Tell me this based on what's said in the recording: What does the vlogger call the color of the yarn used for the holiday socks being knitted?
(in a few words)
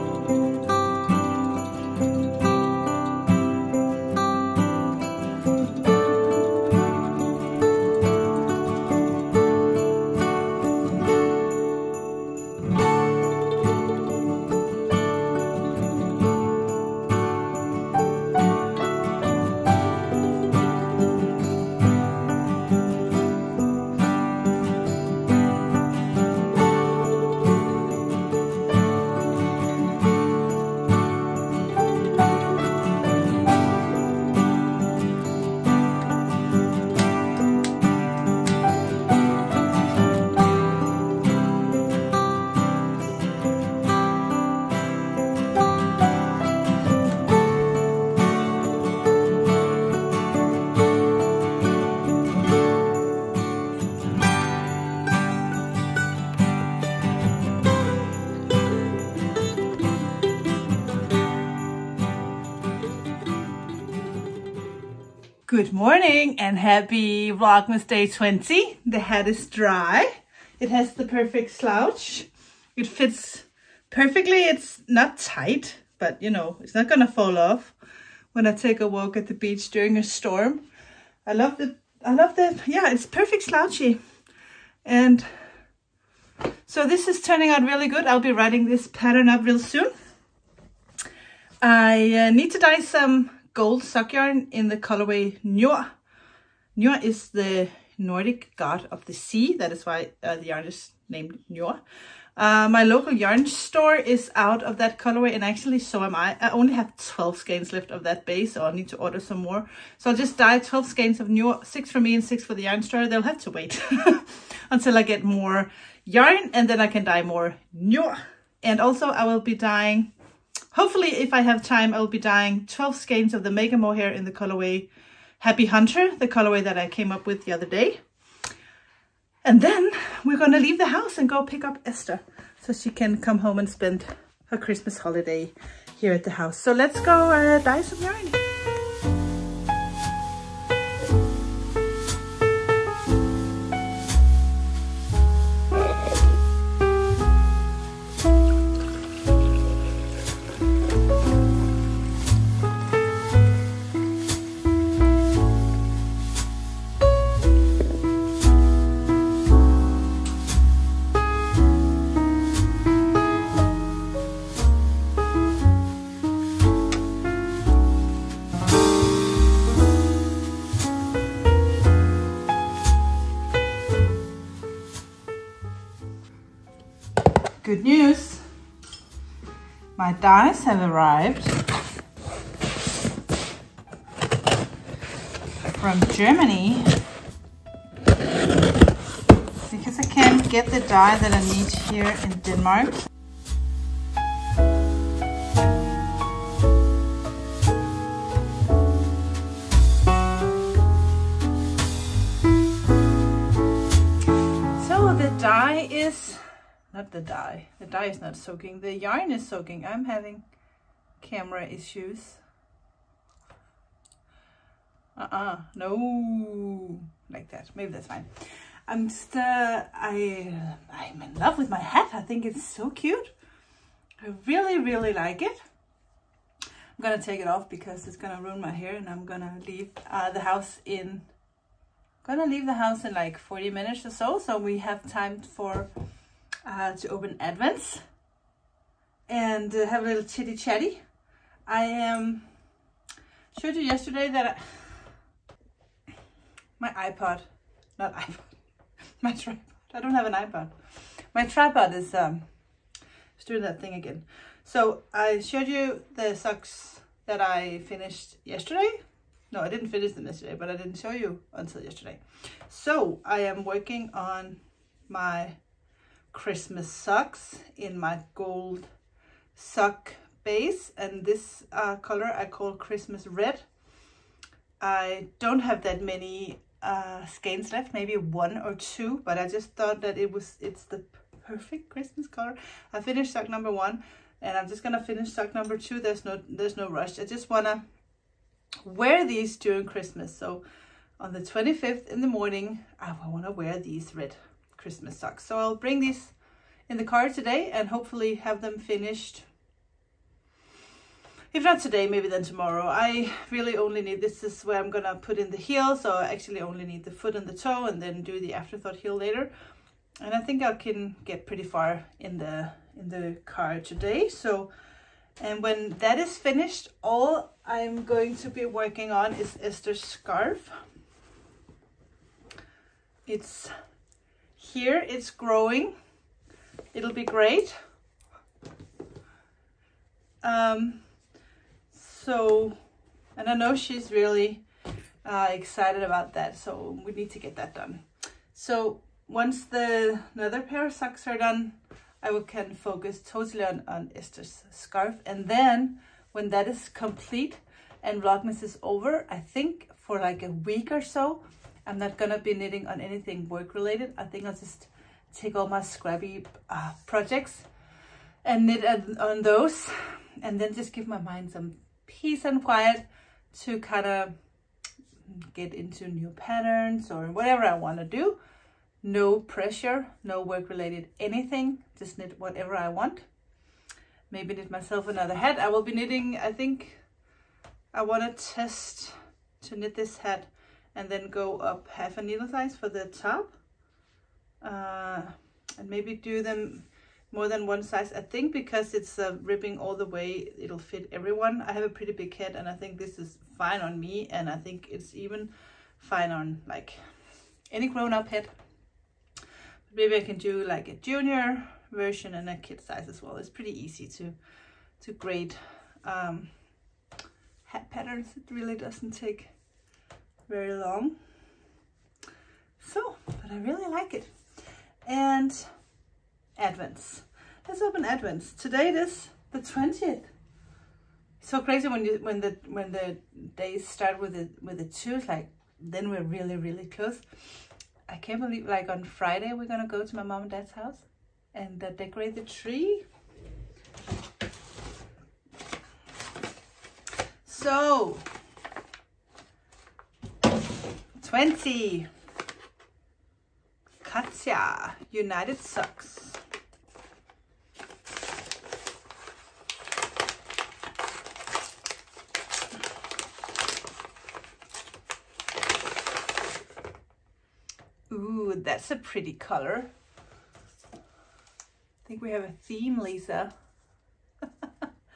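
Christmas red.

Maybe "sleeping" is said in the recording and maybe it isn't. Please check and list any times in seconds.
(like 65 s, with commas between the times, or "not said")
not said.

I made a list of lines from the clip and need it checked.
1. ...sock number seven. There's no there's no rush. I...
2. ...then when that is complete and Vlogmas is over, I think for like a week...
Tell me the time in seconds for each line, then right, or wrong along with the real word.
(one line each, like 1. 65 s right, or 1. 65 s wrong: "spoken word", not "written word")
1. 285 s wrong: "two", not "seven"
2. 345 s right.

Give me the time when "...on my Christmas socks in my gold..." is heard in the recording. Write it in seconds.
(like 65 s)
264 s.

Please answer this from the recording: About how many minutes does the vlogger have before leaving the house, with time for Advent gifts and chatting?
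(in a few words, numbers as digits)
40.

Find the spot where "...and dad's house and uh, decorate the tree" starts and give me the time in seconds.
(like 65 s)
430 s.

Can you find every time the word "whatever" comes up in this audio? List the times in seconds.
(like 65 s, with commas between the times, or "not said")
367 s, 372 s.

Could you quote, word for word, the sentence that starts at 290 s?
So on the 25th in the morning, I wanna wear these red Christmas socks.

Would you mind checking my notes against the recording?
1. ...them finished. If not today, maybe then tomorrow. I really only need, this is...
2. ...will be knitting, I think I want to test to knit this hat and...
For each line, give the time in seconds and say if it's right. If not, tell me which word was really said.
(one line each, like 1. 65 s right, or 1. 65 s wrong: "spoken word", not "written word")
1. 298 s right
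2. 375 s right.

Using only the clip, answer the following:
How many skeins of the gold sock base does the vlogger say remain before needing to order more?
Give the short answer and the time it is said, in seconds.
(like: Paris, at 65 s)
12, at 106 s.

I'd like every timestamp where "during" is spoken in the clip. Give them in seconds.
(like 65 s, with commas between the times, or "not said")
79 s, 289 s.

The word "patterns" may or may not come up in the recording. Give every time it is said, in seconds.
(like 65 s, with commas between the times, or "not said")
88 s, 366 s, 407 s.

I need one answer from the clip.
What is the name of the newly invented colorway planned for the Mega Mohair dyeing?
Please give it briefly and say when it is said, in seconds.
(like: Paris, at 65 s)
Happy Hunter, at 125 s.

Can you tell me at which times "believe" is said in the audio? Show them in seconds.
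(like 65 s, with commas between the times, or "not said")
428 s.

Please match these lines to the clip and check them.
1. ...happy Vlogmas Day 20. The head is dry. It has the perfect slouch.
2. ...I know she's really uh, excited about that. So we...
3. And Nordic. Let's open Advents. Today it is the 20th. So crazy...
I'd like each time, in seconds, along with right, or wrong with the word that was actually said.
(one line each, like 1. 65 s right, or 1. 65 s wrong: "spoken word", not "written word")
1. 66 s right
2. 333 s right
3. 415 s wrong: "Advents", not "Nordic".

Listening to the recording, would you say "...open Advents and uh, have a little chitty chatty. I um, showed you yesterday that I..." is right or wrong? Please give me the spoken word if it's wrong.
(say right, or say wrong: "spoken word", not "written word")
right.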